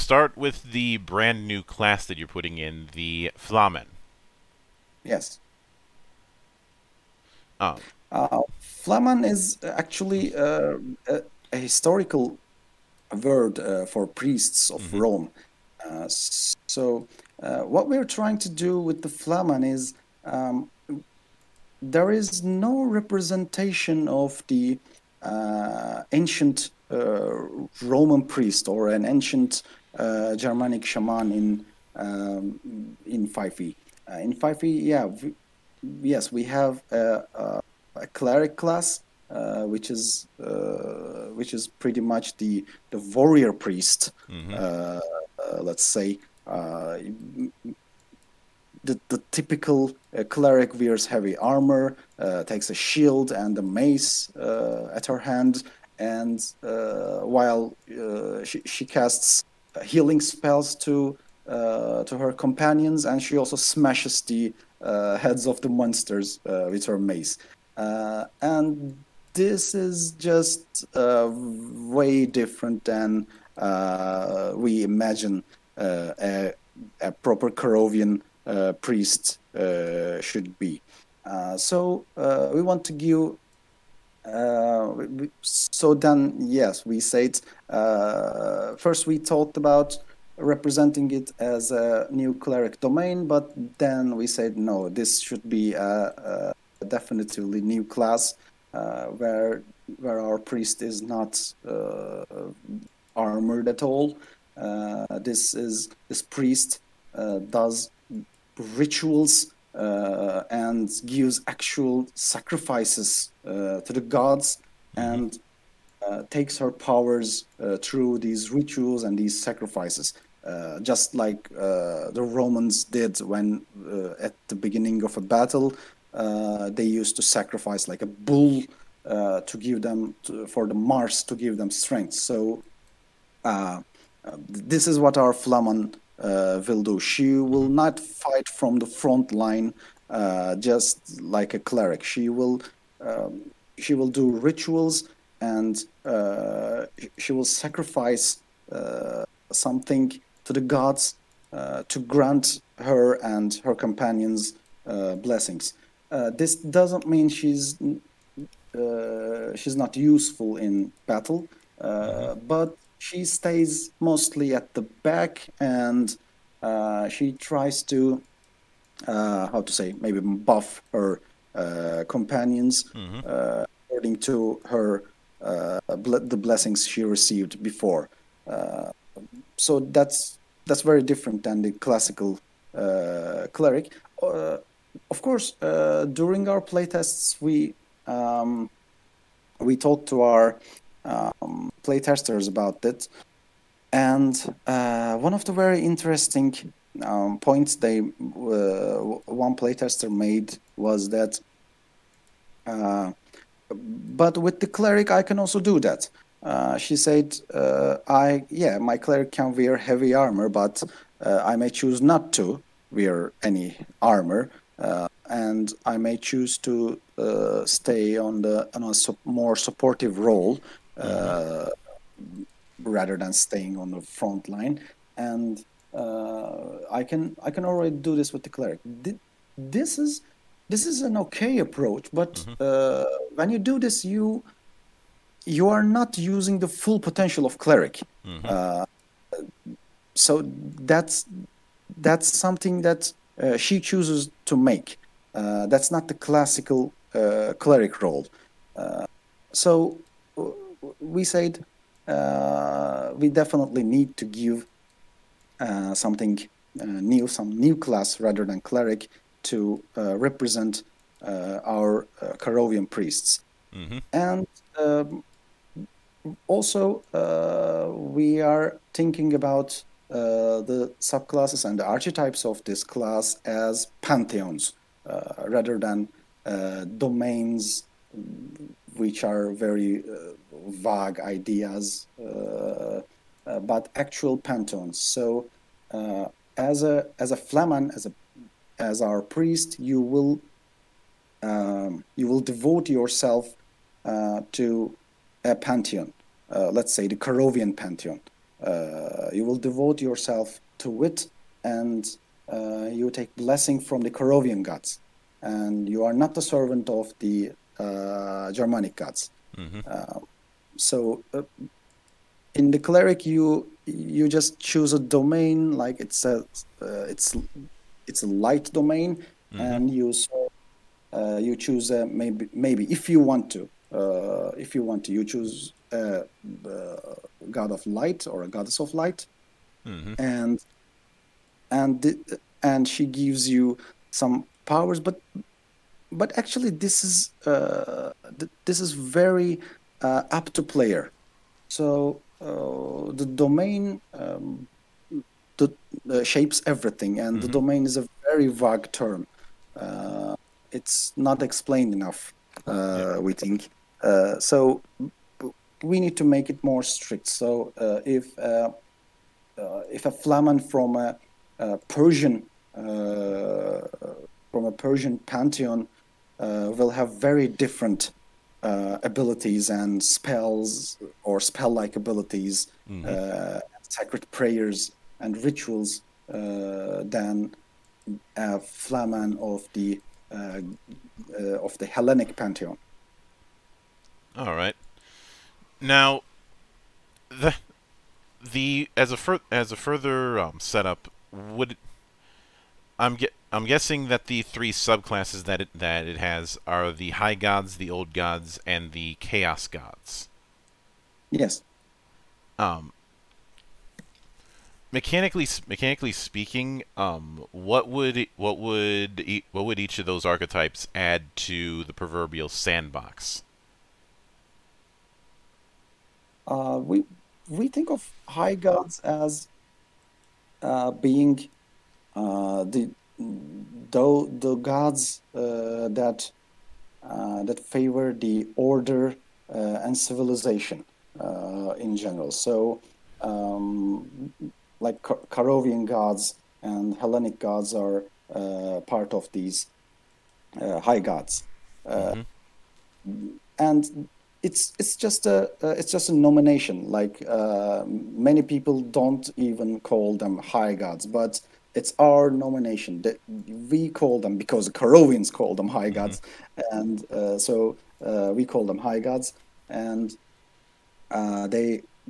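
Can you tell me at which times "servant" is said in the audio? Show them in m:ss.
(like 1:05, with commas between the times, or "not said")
5:06.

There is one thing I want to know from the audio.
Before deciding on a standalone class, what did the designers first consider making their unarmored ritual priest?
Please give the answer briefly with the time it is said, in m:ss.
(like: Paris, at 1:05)
A new cleric domain, at 1:31.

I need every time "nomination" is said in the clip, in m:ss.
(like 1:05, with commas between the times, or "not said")
7:26, 7:32.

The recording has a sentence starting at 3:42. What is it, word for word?
rather than staying on the front line.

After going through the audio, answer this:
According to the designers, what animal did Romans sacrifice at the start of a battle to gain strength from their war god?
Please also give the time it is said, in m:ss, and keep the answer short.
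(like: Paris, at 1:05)
A bull, at 2:08.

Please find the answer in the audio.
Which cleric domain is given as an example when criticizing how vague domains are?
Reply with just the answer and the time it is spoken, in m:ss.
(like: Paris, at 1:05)
Light domain, at 5:18.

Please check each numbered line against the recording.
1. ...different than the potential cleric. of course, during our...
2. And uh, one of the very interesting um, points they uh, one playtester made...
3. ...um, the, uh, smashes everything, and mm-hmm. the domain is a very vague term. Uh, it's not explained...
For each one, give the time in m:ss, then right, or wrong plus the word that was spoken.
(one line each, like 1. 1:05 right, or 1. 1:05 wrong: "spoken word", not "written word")
1. 3:01 wrong: "classical", not "potential"
2. 3:13 right
3. 5:44 wrong: "shapes", not "smashes".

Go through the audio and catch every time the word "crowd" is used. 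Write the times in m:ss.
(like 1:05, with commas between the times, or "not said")
not said.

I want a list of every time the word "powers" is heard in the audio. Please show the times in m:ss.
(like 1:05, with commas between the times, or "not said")
1:56, 5:34.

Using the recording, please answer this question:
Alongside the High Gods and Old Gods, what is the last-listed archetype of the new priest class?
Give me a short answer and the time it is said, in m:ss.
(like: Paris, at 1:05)
The Chaos Gods, at 6:38.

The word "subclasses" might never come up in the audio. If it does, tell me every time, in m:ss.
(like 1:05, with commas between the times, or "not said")
4:31, 6:34.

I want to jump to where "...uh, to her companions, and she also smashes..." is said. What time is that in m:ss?
1:01.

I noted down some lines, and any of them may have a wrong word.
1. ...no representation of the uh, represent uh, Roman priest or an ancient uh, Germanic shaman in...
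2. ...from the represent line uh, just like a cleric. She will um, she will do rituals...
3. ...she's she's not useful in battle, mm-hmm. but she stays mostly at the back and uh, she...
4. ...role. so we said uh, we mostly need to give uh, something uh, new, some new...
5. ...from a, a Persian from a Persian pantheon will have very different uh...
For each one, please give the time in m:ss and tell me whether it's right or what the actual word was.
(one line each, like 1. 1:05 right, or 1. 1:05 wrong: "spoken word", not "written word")
1. 0:22 wrong: "ancient", not "represent"
2. 2:18 wrong: "front", not "represent"
3. 2:37 right
4. 4:08 wrong: "definitely", not "mostly"
5. 6:00 right.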